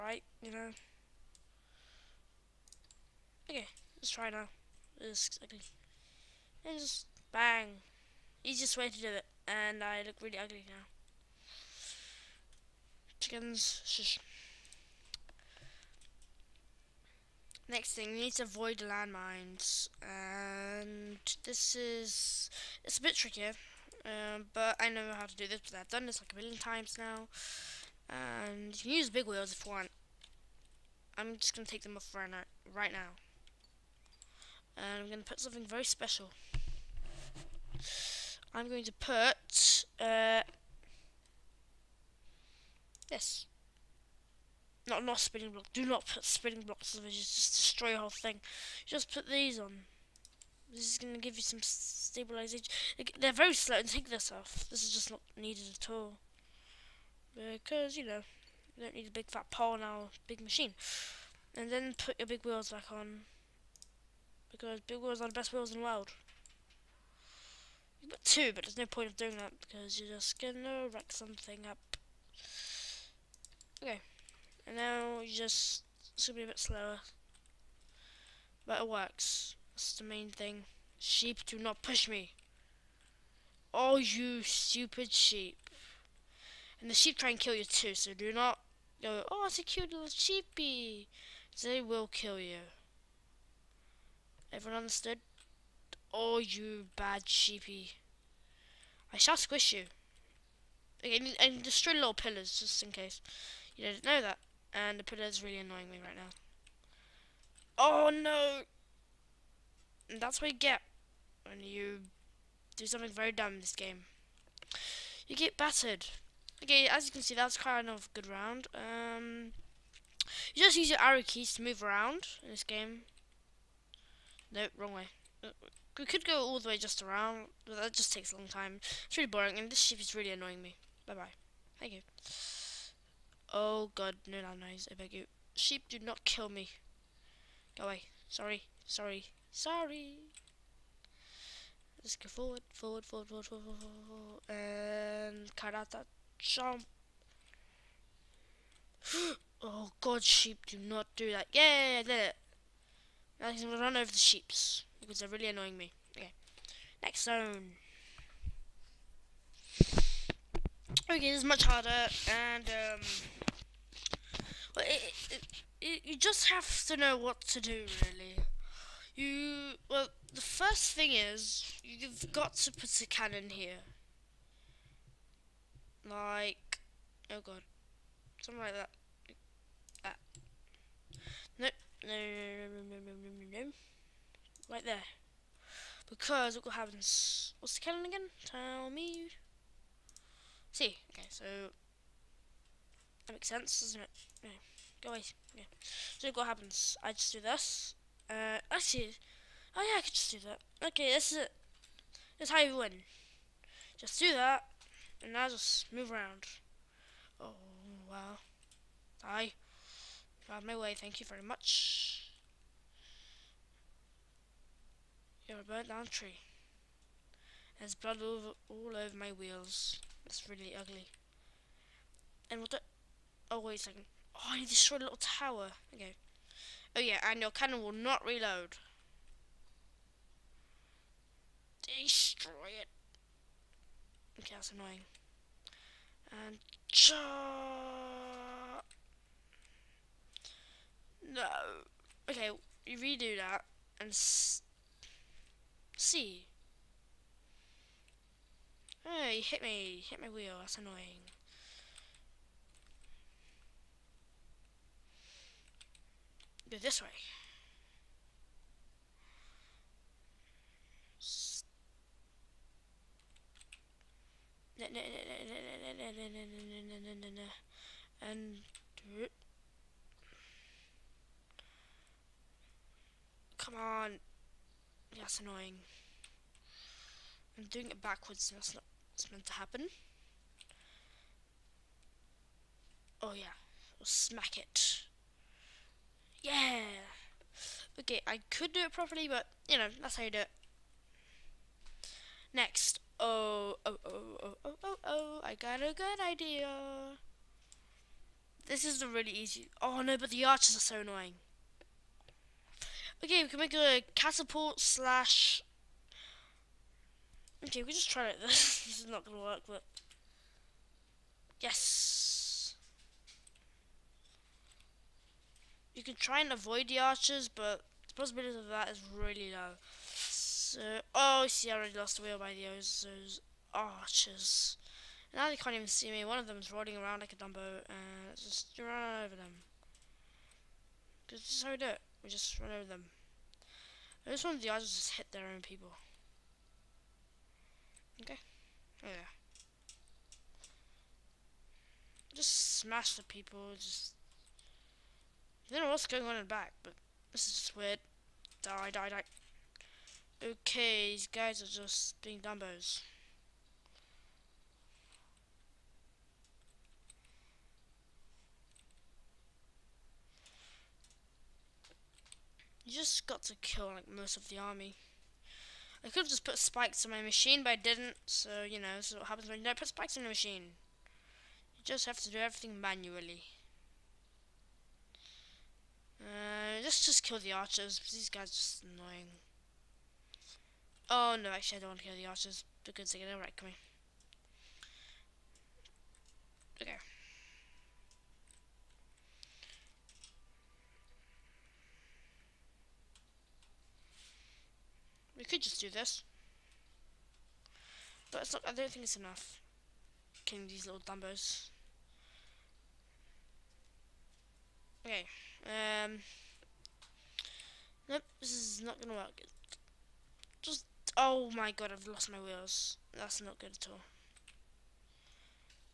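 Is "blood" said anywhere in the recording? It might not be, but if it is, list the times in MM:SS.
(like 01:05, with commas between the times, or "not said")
03:37.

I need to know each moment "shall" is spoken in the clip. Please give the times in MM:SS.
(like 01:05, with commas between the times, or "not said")
01:39.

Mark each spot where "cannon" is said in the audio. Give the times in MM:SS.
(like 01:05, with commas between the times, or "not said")
02:53, 03:07, 03:47.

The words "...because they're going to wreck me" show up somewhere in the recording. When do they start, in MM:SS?
06:22.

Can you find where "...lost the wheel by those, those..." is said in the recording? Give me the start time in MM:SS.
05:21.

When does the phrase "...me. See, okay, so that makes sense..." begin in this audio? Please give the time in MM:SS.
03:08.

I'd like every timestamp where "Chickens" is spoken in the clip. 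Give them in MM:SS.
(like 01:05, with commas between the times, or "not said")
00:13.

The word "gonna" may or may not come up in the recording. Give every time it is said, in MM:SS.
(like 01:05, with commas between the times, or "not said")
01:10, 01:16, 02:33, 06:49.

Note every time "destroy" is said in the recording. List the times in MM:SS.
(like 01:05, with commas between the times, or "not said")
00:47, 01:41, 03:44, 03:52.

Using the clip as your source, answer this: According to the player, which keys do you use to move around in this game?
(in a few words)
arrow keys.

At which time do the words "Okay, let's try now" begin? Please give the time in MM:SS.
00:03.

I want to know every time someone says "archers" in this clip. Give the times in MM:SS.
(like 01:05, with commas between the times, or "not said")
05:00, 05:16, 05:23, 06:17, 06:22.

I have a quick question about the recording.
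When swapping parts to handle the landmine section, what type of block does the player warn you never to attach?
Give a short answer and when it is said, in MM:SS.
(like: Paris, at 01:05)
spinning blocks, at 00:46.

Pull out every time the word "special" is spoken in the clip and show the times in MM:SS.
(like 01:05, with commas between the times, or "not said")
00:35.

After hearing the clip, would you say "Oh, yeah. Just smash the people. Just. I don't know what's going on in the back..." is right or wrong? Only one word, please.
right.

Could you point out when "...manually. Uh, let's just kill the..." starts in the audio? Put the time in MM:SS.
06:12.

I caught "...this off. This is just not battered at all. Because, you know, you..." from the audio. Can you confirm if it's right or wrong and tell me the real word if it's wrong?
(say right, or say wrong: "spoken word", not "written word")
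wrong: "needed", not "battered".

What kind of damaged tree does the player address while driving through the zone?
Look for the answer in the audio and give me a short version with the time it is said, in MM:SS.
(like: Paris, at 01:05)
burnt down tree, at 03:35.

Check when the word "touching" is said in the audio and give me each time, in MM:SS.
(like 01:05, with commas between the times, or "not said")
not said.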